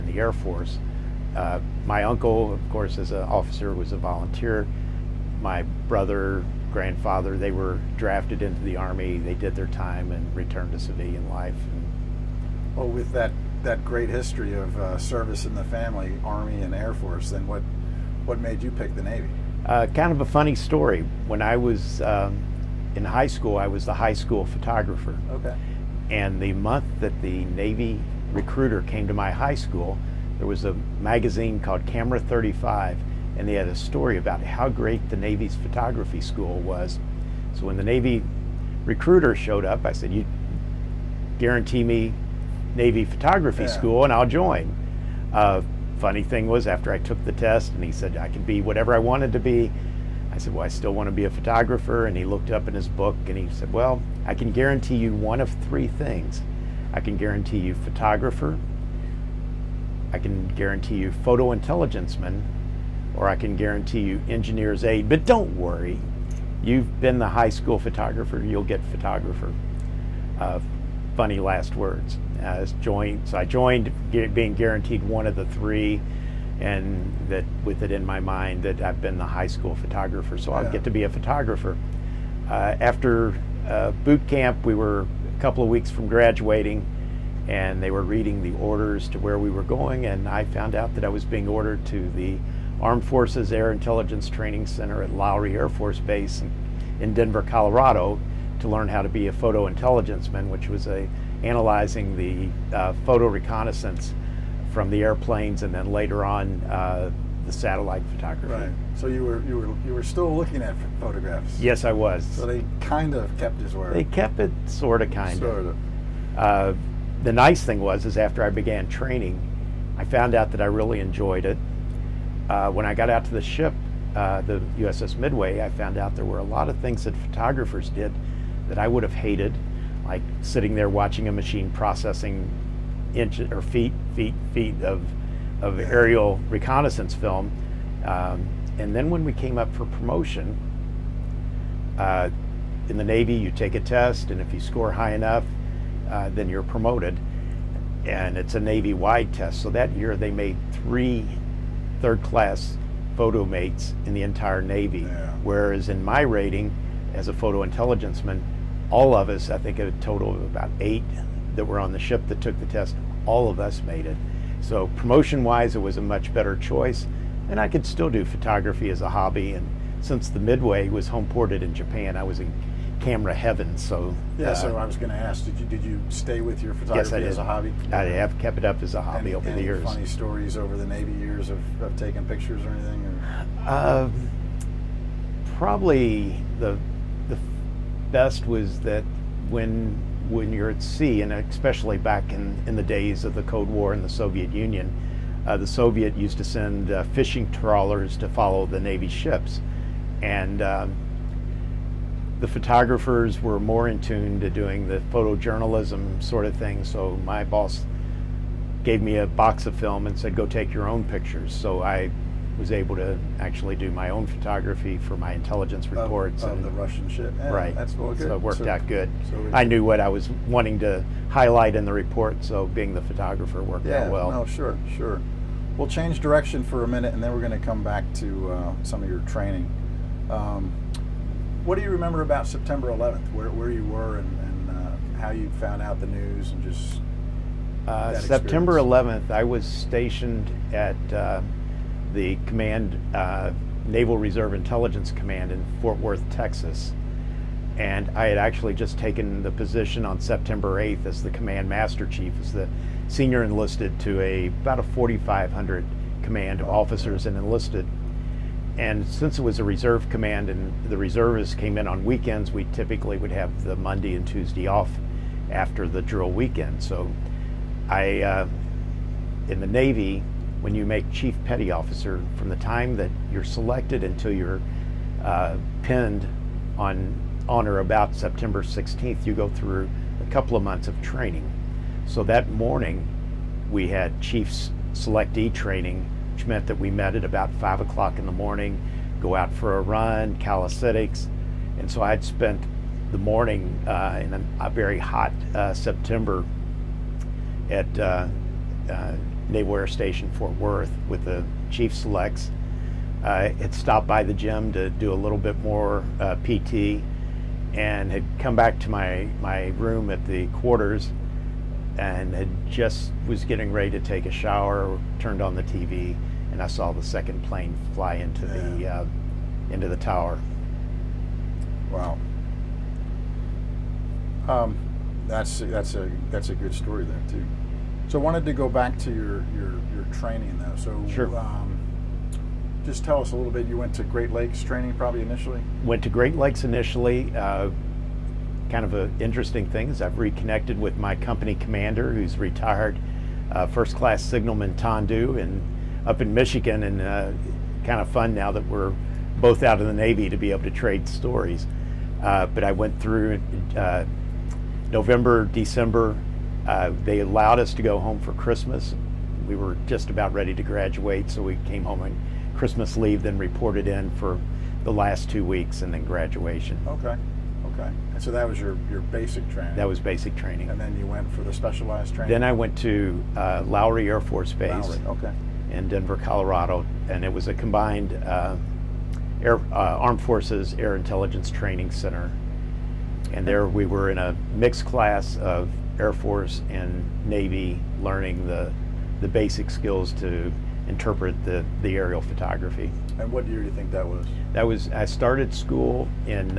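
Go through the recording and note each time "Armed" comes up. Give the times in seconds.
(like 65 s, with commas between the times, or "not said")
92 s, 379 s.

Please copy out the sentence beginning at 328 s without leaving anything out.
So I wanted to go back to your your, your training though.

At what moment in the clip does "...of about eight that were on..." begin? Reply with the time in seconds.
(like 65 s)
160 s.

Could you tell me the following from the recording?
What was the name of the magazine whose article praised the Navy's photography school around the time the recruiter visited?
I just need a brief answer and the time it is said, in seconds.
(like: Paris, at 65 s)
Camera 35, at 31 s.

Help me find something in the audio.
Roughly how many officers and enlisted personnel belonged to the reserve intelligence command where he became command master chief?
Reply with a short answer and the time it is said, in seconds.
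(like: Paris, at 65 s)
4,500, at 254 s.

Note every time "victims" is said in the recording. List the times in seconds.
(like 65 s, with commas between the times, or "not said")
not said.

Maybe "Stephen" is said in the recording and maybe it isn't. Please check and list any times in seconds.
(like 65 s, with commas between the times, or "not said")
not said.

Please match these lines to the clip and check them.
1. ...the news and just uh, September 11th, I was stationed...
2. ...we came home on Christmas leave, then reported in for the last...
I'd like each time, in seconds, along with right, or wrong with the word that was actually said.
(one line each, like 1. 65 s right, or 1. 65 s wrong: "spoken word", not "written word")
1. 236 s right
2. 361 s right.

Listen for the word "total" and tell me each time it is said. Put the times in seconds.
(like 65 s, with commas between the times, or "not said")
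159 s.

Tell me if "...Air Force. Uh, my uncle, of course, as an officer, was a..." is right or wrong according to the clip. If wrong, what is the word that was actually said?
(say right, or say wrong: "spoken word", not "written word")
right.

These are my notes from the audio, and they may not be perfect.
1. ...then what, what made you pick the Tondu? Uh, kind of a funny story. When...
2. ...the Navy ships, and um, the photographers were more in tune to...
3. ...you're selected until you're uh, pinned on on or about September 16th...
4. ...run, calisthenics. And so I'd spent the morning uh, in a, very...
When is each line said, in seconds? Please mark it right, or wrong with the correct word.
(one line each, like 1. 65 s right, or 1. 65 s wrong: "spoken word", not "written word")
1. 17 s wrong: "Navy", not "Tondu"
2. 198 s right
3. 273 s right
4. 289 s right.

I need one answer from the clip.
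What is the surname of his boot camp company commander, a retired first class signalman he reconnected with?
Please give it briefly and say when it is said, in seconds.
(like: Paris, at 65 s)
Tondu, at 344 s.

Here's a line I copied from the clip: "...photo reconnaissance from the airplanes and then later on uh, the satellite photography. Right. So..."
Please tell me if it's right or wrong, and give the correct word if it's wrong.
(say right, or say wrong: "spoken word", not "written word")
right.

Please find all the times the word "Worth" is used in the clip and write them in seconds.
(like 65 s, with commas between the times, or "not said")
246 s, 300 s.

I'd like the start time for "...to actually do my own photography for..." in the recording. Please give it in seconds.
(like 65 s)
212 s.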